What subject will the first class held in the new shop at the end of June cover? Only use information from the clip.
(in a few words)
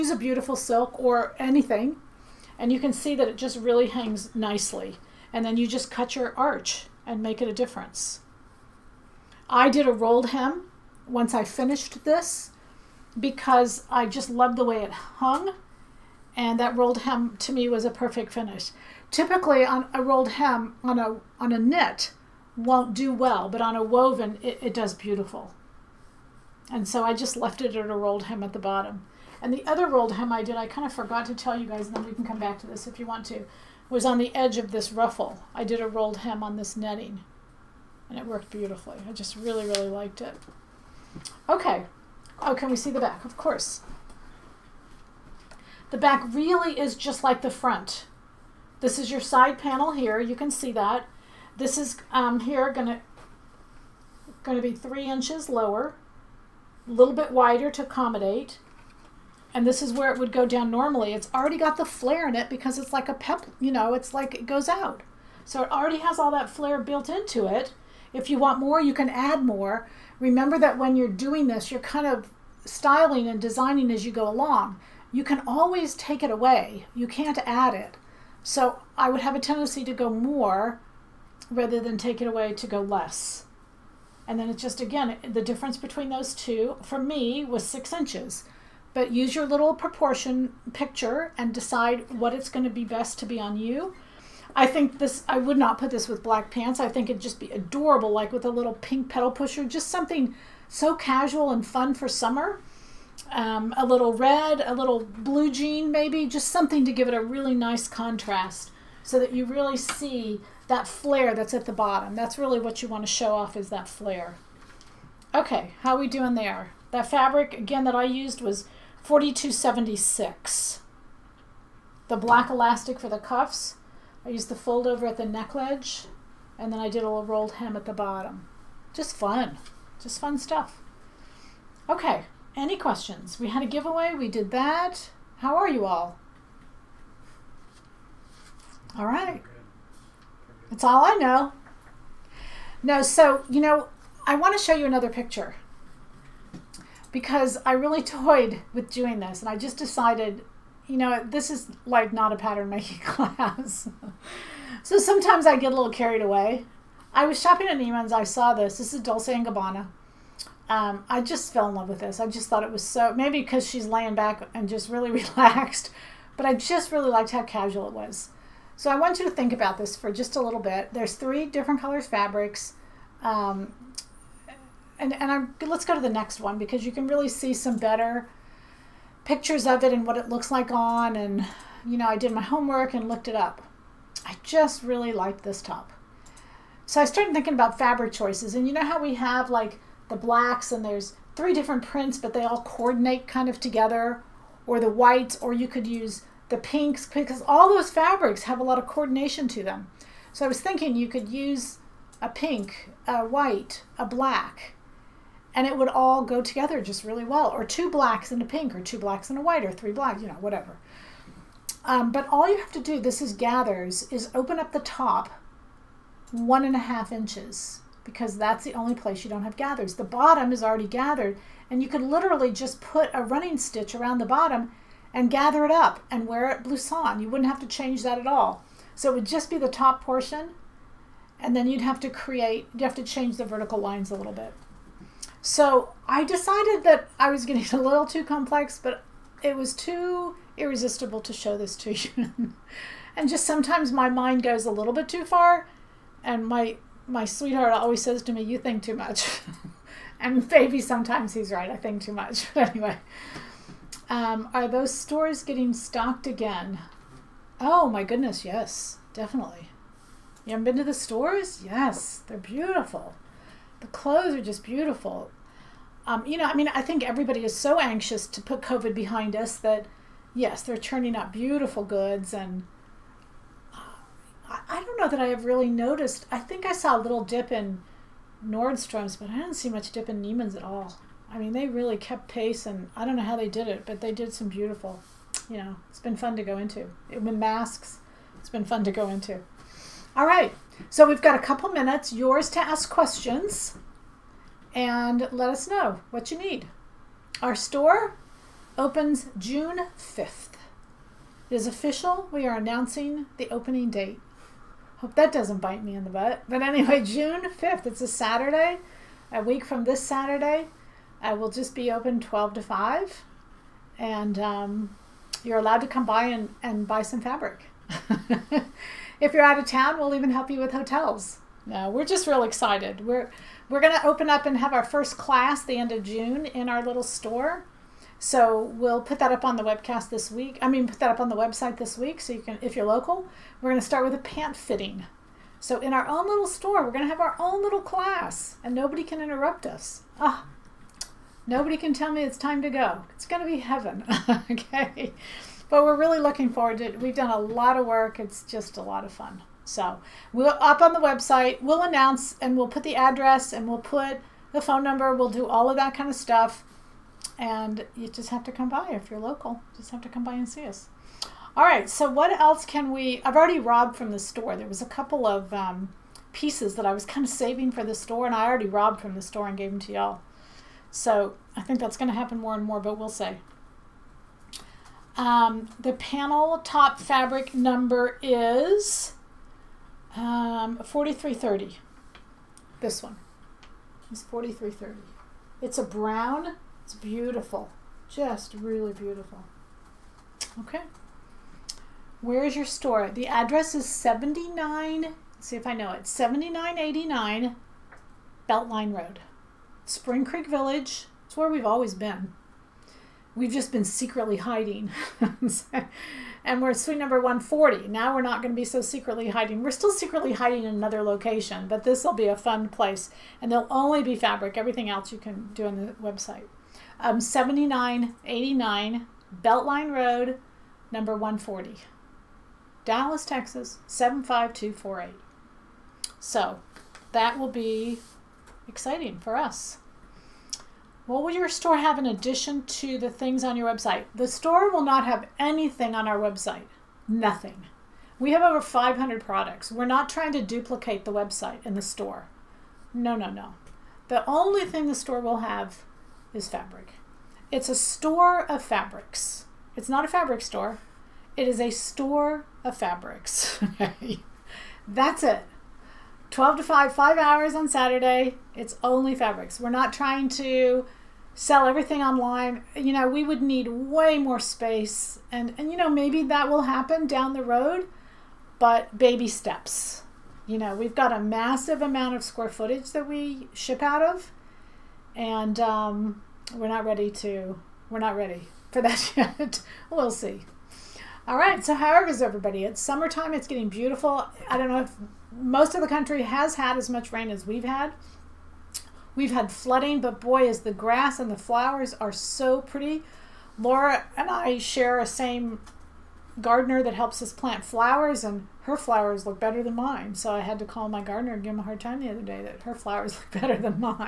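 Pant fitting.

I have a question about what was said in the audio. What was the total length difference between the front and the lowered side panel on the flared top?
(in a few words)
6 inches.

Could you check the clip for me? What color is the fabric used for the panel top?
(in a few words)
Brown.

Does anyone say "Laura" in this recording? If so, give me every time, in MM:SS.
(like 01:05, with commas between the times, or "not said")
08:13.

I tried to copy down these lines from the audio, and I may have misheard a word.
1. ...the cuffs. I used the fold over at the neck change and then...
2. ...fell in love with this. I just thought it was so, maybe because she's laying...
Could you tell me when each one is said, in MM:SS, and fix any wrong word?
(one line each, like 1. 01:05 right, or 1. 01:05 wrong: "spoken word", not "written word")
1. 02:03 wrong: "ledge", not "change"
2. 02:41 right.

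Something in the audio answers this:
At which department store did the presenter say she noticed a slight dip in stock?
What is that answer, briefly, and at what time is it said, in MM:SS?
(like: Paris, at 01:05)
Nordstrom's, at 04:38.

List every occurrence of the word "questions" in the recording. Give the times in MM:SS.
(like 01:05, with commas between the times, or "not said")
02:12, 04:52.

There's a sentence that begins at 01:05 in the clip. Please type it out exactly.
So it already has all that flare built into it.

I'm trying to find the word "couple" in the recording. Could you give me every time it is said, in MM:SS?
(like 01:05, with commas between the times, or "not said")
04:51, 06:04.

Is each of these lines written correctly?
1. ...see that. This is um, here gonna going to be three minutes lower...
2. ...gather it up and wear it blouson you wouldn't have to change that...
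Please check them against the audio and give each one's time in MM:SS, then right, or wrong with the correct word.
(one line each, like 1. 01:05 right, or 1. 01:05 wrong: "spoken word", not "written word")
1. 00:50 wrong: "inches", not "minutes"
2. 03:45 right.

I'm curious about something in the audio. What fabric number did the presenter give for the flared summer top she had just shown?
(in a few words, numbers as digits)
4276.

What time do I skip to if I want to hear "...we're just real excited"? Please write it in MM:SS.
05:21.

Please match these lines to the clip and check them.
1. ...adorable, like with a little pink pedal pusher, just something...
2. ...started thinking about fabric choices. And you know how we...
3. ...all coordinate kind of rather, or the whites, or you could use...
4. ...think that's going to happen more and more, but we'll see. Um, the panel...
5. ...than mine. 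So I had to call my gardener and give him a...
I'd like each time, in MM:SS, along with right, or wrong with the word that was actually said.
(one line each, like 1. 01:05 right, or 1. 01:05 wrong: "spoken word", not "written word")
1. 01:37 right
2. 03:07 right
3. 03:12 wrong: "together", not "rather"
4. 06:11 right
5. 08:19 right.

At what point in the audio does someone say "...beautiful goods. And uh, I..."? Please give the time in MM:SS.
04:31.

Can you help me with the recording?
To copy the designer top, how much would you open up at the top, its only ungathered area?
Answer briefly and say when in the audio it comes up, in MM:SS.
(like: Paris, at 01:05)
1.5 inches, at 03:36.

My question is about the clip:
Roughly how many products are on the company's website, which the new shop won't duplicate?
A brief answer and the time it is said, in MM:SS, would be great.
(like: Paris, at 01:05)
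Over 500, at 07:18.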